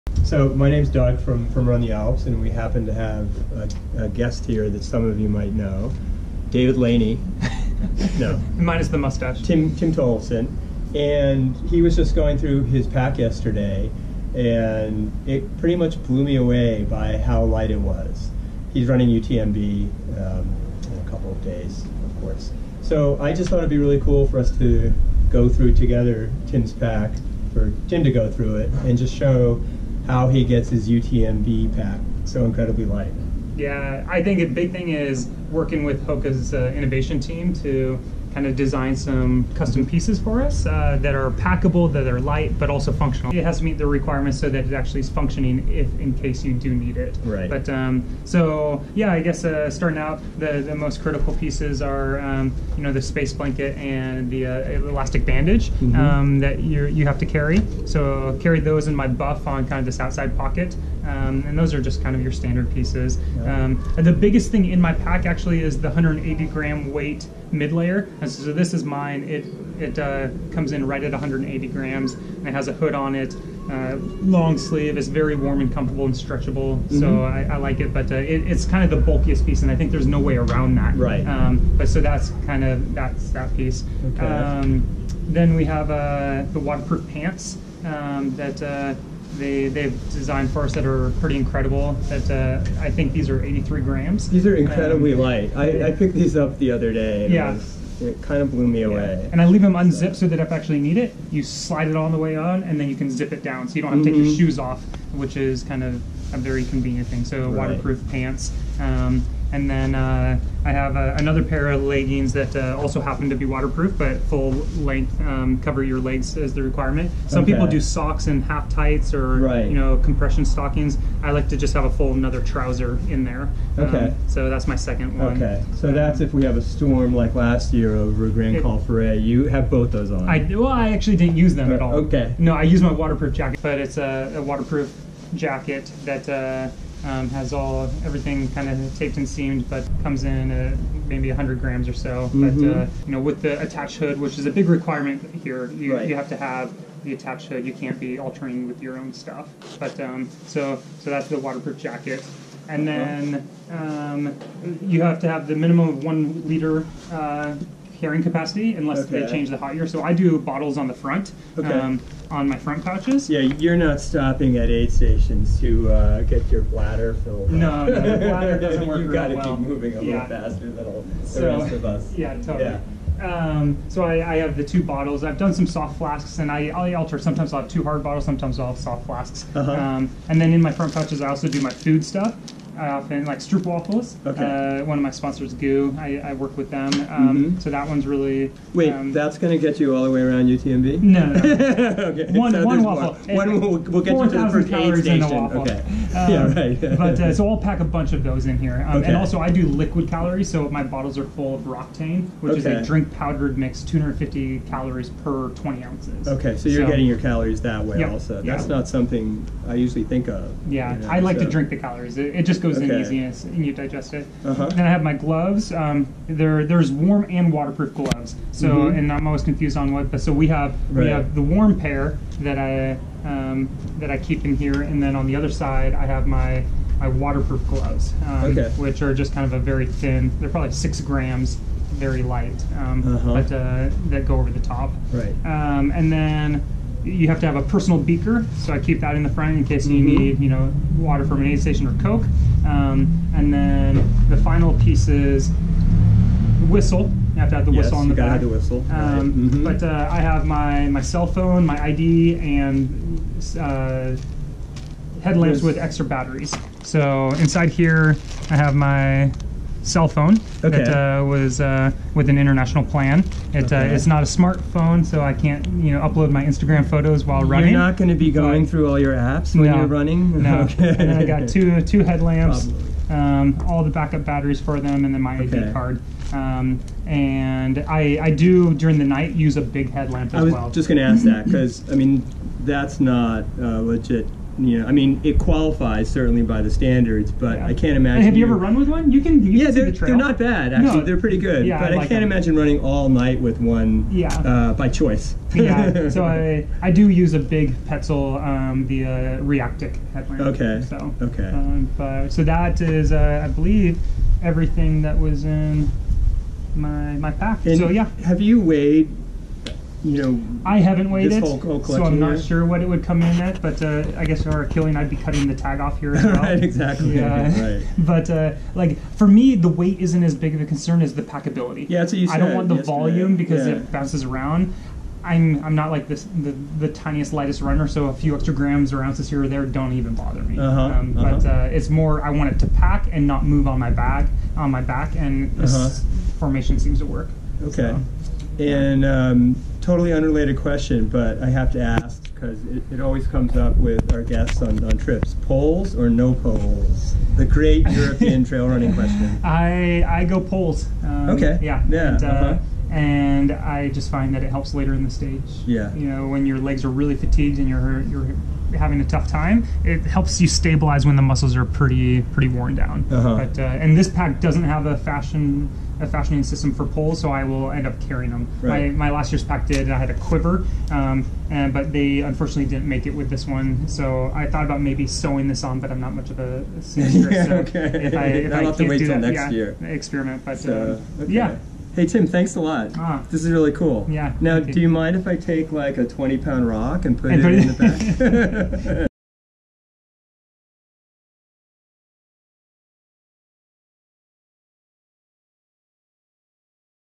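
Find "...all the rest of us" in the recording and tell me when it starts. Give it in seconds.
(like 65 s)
170 s.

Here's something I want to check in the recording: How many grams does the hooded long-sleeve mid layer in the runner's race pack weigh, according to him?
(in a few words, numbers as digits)
180.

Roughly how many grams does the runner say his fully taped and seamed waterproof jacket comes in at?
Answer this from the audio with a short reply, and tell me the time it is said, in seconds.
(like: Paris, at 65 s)
100, at 141 s.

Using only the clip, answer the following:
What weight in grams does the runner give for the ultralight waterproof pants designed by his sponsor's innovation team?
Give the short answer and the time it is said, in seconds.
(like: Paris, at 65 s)
83, at 93 s.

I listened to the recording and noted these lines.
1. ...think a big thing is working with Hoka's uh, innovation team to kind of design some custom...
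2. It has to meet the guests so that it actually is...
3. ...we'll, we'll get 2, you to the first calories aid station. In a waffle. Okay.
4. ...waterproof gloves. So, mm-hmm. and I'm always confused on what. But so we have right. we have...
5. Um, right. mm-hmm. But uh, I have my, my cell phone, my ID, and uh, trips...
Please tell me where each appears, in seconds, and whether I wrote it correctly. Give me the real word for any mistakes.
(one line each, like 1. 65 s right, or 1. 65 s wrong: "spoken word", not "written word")
1. 34 s right
2. 43 s wrong: "requirements", not "guests"
3. 193 s wrong: "4", not "2"
4. 217 s right
5. 248 s wrong: "headlamps", not "trips".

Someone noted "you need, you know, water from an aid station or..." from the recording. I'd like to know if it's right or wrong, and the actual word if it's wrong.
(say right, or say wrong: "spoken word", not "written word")
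right.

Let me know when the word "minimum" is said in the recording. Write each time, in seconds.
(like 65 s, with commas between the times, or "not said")
155 s.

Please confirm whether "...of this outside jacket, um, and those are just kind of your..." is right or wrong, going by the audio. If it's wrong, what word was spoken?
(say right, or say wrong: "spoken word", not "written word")
wrong: "pocket", not "jacket".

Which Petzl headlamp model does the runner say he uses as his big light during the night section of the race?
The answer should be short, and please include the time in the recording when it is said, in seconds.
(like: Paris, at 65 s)
Reactik, at 299 s.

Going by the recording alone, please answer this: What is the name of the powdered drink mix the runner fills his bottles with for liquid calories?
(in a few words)
Roctane.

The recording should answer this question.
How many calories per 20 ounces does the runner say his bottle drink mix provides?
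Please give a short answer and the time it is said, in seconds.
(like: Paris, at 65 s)
250, at 203 s.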